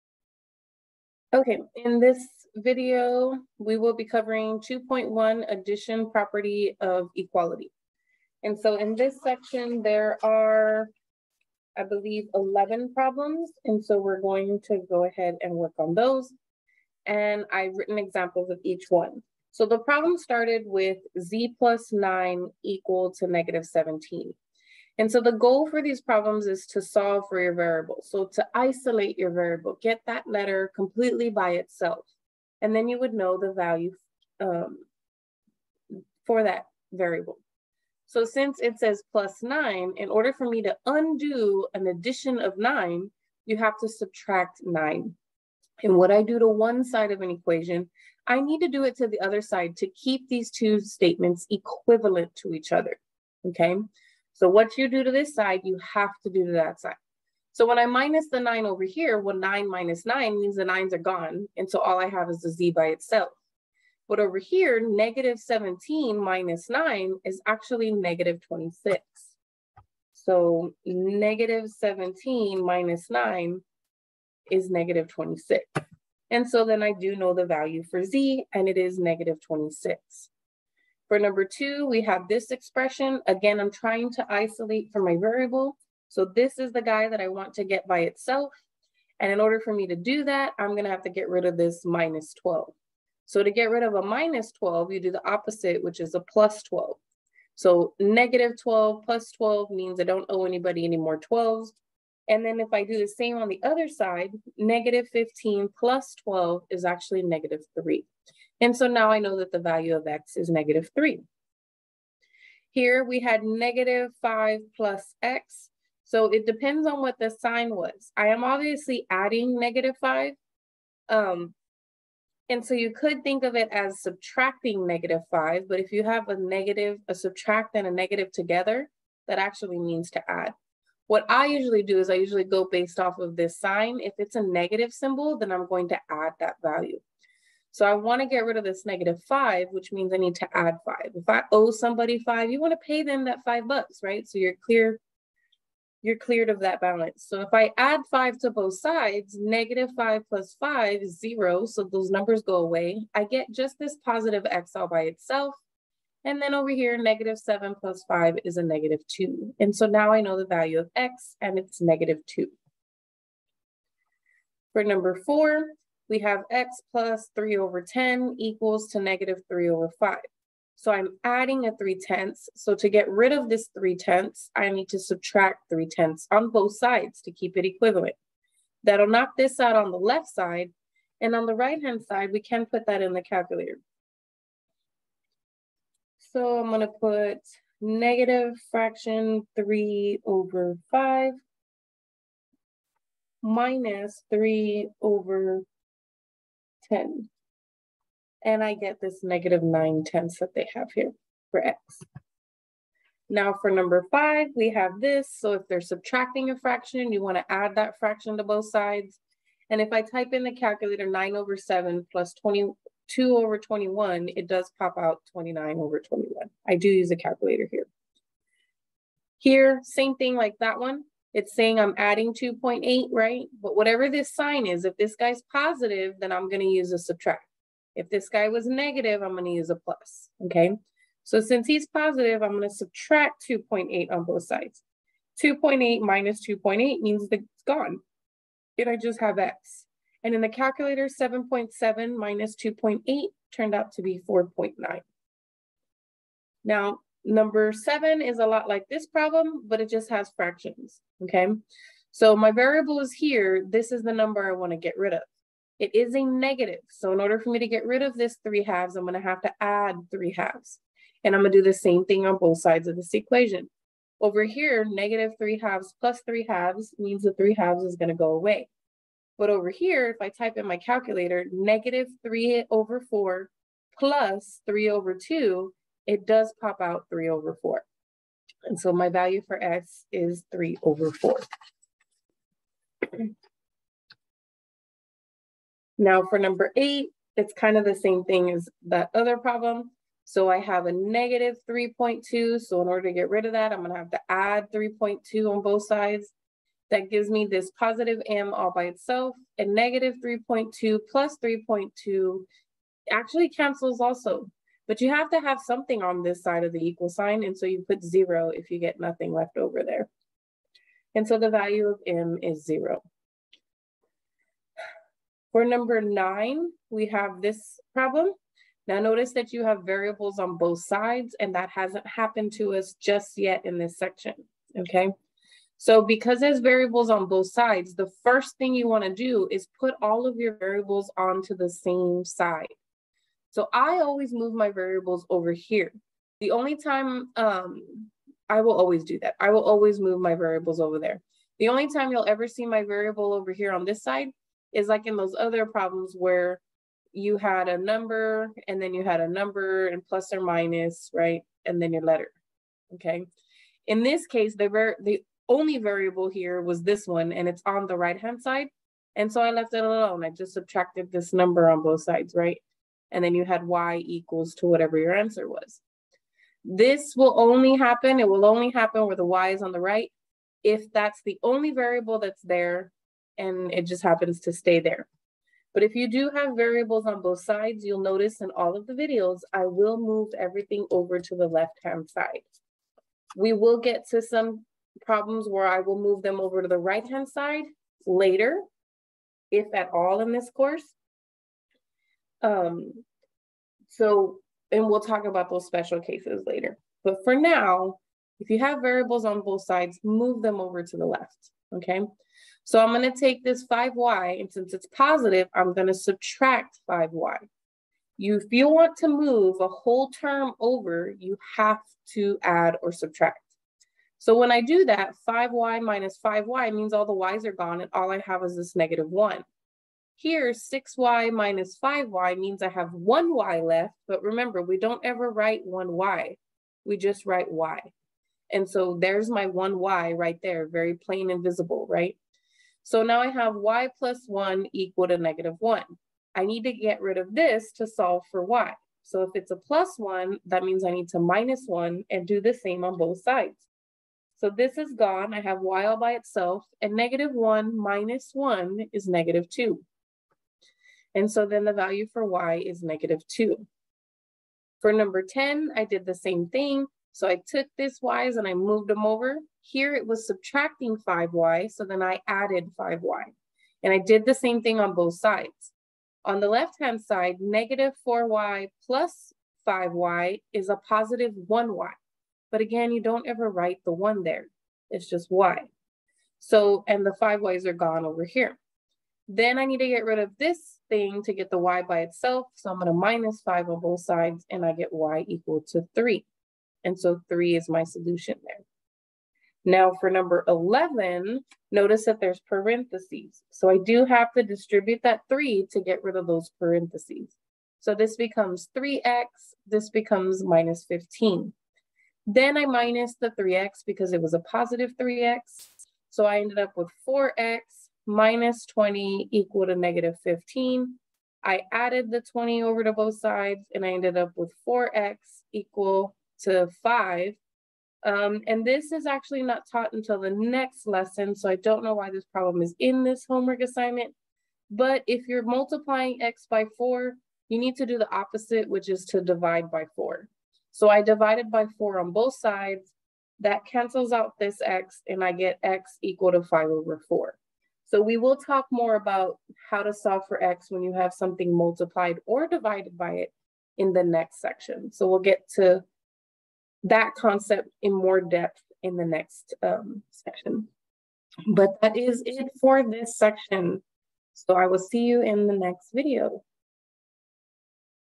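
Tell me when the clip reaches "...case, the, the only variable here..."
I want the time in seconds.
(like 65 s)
354 s.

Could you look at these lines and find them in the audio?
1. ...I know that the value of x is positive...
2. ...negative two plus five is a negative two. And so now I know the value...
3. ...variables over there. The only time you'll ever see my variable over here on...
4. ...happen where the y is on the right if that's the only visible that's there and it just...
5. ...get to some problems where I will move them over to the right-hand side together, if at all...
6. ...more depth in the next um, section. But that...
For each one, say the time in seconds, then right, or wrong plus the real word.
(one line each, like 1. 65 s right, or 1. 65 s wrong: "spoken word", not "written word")
1. 109 s wrong: "negative", not "positive"
2. 156 s wrong: "seven", not "two"
3. 340 s right
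4. 368 s wrong: "variable", not "visible"
5. 383 s wrong: "later", not "together"
6. 547 s right.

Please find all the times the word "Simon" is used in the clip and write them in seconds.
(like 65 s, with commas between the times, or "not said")
not said.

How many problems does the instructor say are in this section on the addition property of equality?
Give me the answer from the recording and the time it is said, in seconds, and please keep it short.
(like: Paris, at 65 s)
11, at 12 s.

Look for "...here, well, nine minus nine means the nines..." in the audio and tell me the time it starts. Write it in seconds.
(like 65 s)
58 s.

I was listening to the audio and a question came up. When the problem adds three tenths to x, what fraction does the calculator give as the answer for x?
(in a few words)
-9/10.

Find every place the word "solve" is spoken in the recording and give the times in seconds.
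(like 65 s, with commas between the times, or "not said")
26 s, 437 s, 539 s.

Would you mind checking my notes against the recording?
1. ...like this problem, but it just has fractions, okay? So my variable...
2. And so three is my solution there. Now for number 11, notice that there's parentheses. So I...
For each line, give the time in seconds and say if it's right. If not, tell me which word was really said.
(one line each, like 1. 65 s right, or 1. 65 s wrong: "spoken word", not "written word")
1. 248 s right
2. 486 s right.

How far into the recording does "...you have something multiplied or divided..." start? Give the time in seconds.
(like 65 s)
540 s.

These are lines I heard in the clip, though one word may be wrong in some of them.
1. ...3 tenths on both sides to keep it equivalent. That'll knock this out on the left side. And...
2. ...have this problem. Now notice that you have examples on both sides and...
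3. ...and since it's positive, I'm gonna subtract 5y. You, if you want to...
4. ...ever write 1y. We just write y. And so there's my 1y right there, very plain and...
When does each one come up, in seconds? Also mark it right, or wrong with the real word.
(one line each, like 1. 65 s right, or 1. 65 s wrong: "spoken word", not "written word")
1. 175 s right
2. 317 s wrong: "variables", not "examples"
3. 404 s right
4. 425 s right.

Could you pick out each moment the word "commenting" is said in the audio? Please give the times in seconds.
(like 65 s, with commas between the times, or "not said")
not said.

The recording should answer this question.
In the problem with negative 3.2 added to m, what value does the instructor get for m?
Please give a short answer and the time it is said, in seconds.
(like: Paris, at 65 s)
0, at 311 s.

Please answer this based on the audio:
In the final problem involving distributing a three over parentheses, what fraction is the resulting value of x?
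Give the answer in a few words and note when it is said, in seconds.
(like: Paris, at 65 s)
5/4, at 536 s.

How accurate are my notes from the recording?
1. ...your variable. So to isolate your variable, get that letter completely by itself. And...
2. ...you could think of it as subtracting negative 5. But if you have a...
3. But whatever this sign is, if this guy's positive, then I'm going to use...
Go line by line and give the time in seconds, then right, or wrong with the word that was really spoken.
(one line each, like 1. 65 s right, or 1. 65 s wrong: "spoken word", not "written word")
1. 27 s right
2. 122 s right
3. 223 s right.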